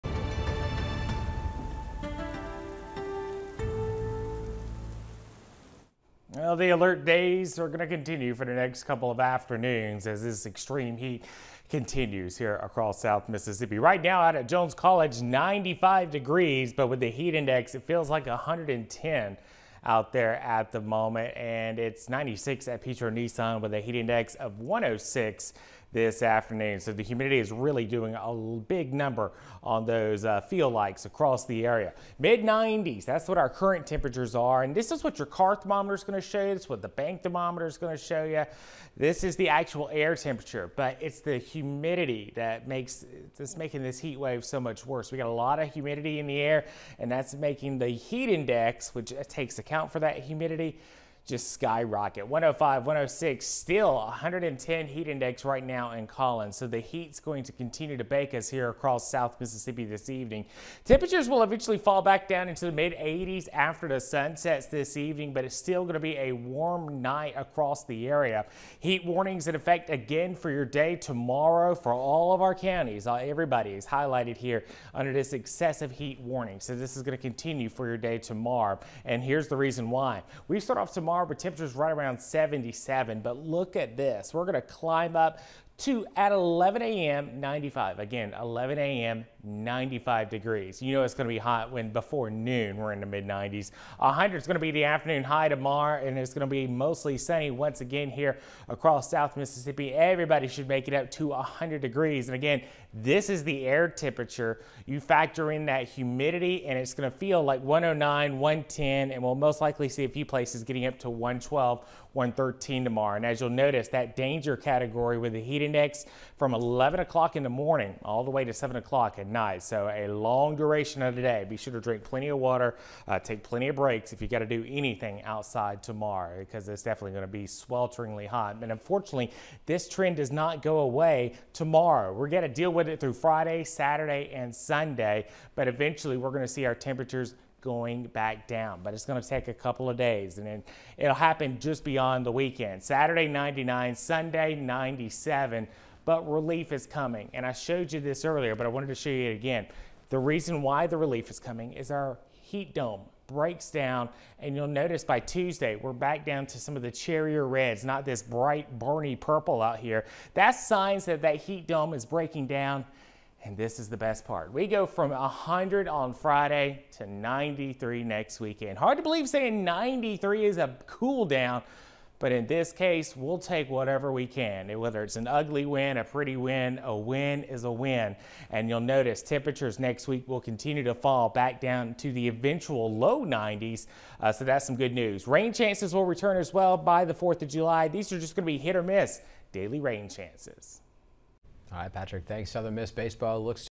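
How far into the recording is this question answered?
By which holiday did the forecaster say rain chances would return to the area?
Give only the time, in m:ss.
3:07.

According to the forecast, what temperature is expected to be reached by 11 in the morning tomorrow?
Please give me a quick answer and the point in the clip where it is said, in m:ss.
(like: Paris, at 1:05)
95, at 1:28.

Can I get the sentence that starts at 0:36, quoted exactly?
It's what the bank thermometer is going to show you.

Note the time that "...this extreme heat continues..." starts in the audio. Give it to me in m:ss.
0:10.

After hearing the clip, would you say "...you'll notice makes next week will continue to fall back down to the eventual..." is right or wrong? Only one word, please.
wrong.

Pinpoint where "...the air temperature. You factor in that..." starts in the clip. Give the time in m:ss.
1:43.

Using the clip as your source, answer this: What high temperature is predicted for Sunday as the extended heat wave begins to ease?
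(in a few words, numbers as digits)
97.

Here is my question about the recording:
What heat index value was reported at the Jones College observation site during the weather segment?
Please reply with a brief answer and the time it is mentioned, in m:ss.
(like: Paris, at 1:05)
110, at 0:17.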